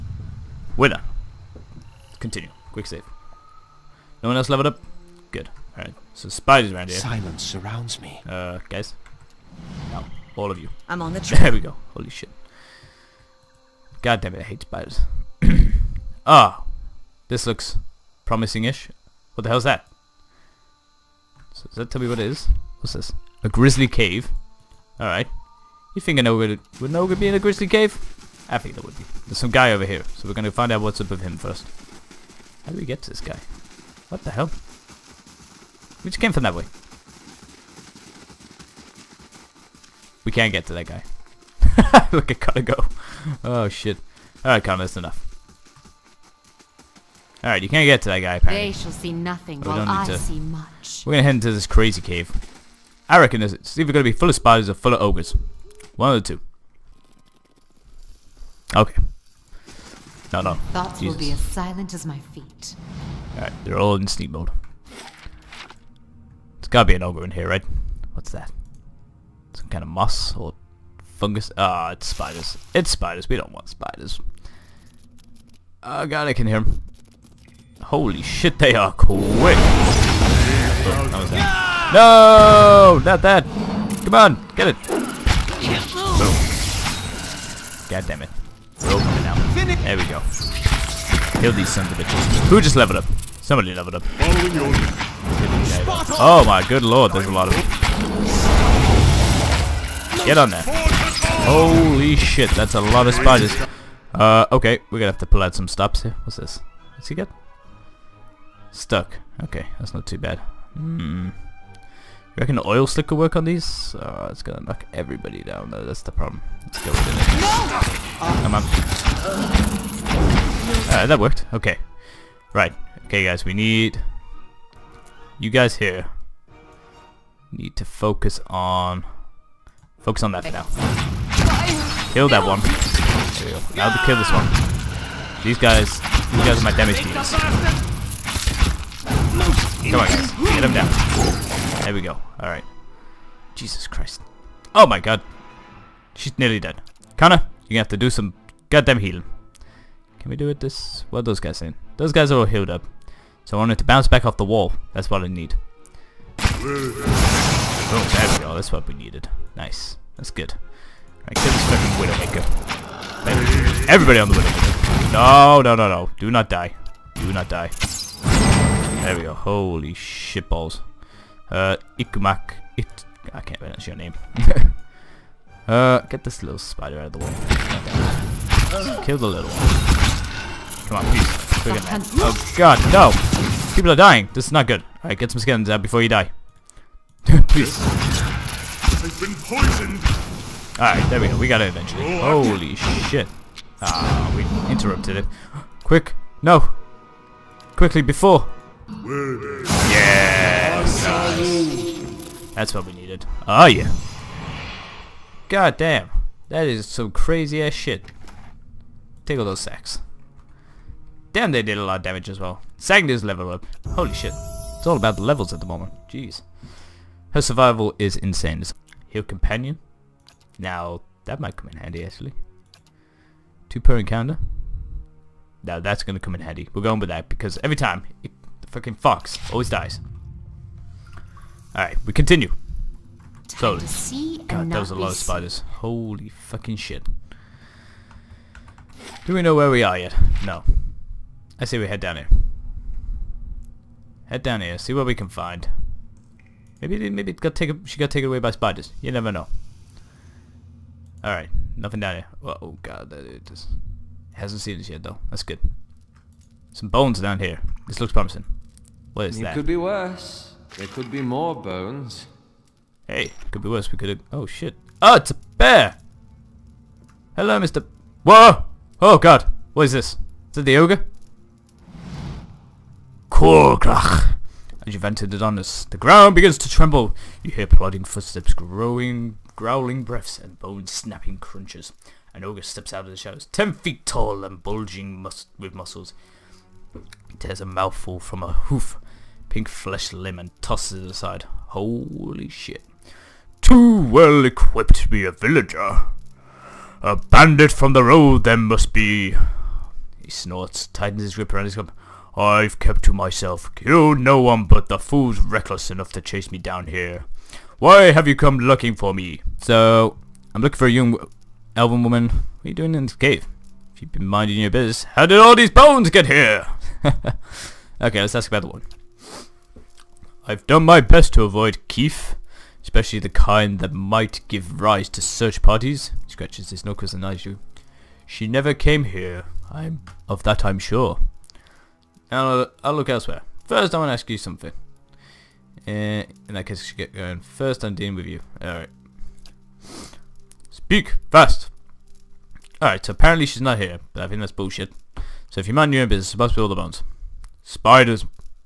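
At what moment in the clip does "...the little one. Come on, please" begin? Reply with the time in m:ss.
2:59.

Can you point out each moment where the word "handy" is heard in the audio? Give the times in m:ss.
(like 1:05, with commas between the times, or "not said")
3:41, 3:46.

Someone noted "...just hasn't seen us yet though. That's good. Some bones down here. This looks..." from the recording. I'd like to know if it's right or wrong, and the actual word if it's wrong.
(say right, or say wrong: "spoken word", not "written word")
right.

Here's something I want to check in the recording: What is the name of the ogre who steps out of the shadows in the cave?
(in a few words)
Korgrak.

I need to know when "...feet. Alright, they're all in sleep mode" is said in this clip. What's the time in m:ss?
1:02.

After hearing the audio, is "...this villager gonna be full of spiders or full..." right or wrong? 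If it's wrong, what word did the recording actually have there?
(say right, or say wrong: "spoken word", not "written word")
wrong: "either", not "villager".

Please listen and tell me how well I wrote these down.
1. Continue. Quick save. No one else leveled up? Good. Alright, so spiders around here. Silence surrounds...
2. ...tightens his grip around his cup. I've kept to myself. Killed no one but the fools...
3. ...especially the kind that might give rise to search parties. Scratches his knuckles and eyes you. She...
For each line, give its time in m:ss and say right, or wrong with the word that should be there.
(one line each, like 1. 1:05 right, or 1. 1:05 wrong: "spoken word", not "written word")
1. 0:02 right
2. 5:00 right
3. 5:22 right.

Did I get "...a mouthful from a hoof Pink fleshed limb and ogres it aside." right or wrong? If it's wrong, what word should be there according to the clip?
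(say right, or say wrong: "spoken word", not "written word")
wrong: "tosses", not "ogres".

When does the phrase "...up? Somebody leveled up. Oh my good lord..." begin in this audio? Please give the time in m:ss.
1:32.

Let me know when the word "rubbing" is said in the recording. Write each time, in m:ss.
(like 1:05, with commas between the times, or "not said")
not said.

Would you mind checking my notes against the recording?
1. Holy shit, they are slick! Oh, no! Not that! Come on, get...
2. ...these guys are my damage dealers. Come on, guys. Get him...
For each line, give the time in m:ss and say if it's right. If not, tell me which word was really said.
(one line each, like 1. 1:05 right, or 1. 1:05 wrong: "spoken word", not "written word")
1. 1:17 wrong: "quick", not "slick"
2. 2:16 right.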